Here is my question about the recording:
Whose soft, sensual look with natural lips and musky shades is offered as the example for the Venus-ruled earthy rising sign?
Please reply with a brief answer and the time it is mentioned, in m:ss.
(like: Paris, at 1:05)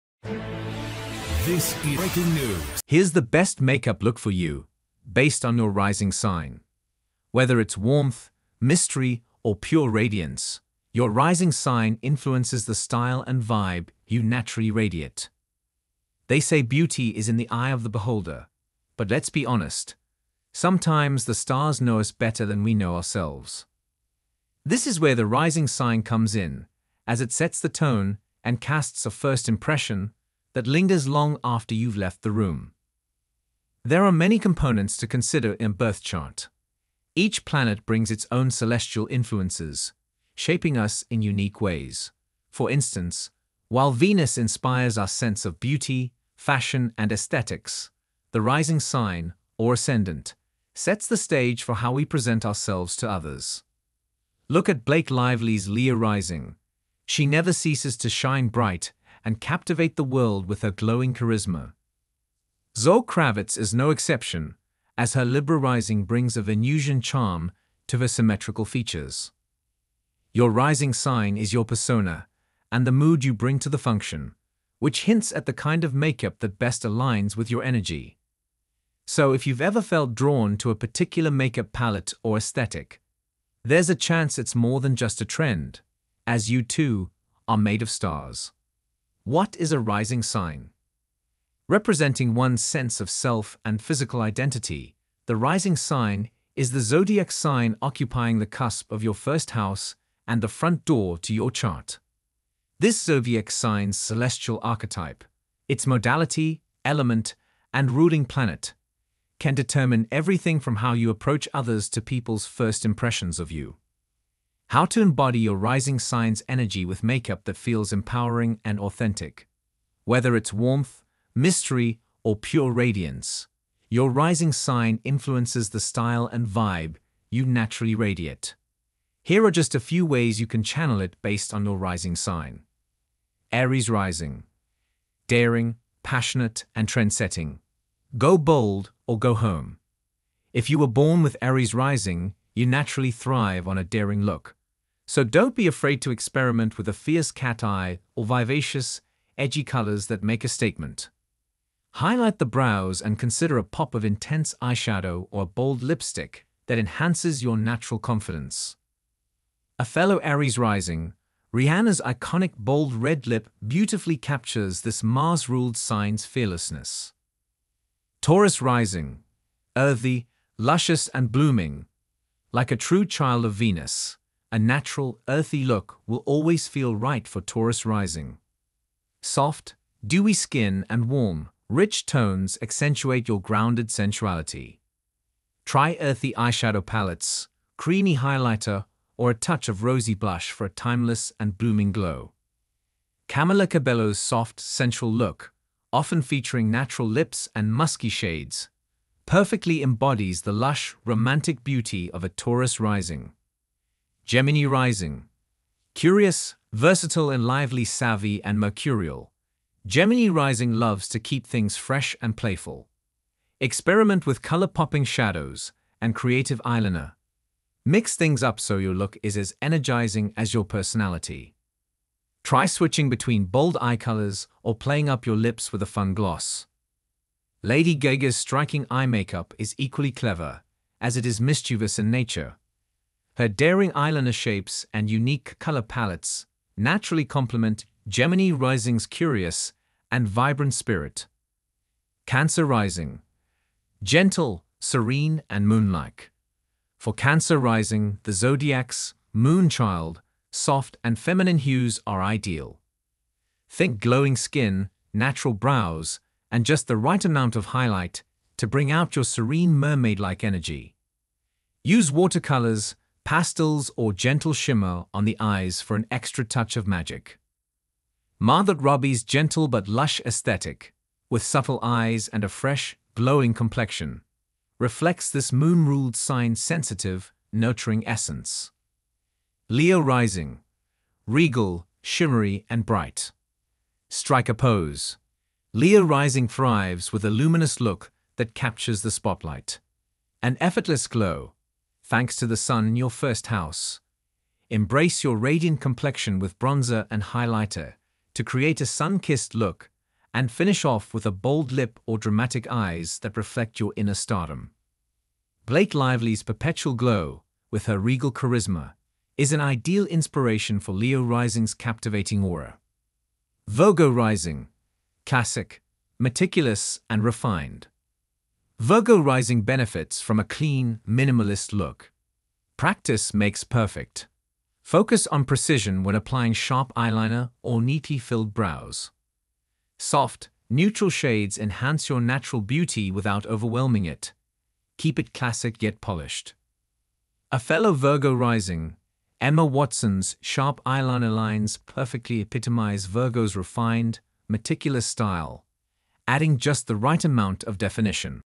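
Camila Cabello, at 3:13.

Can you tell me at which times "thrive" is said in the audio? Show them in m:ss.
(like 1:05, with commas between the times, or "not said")
2:23, 4:46.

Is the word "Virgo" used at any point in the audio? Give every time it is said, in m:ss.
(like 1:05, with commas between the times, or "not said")
5:13, 5:18, 5:37, 5:43.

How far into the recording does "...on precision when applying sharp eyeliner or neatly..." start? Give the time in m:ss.
5:25.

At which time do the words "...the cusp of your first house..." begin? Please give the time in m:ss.
1:38.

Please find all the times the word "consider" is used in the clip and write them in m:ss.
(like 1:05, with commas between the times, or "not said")
0:35, 2:33.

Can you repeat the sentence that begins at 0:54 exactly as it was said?
Look at Blake Lively's Leo rising.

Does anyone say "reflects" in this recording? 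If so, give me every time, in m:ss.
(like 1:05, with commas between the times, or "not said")
4:34, 5:03.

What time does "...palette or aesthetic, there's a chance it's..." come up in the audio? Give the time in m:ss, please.
1:21.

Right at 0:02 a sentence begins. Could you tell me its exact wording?
Here's the best makeup look for you, based on your rising sign.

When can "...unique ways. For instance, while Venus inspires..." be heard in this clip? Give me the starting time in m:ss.
0:41.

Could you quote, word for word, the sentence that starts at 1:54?
How to embody your rising signs energy with makeup that feels empowering and authentic.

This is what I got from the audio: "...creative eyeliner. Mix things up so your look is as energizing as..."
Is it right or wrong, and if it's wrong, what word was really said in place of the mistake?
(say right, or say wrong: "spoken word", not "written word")
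right.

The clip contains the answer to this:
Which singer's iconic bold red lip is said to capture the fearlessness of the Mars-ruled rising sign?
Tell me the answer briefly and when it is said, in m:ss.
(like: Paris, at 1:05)
Rihanna, at 2:41.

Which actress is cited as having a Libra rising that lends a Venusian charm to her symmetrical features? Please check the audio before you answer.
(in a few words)
Zoe Kravitz.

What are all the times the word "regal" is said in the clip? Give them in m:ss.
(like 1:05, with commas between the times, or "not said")
4:41, 5:07.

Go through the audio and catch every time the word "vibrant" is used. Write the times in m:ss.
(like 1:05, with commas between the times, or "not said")
4:00.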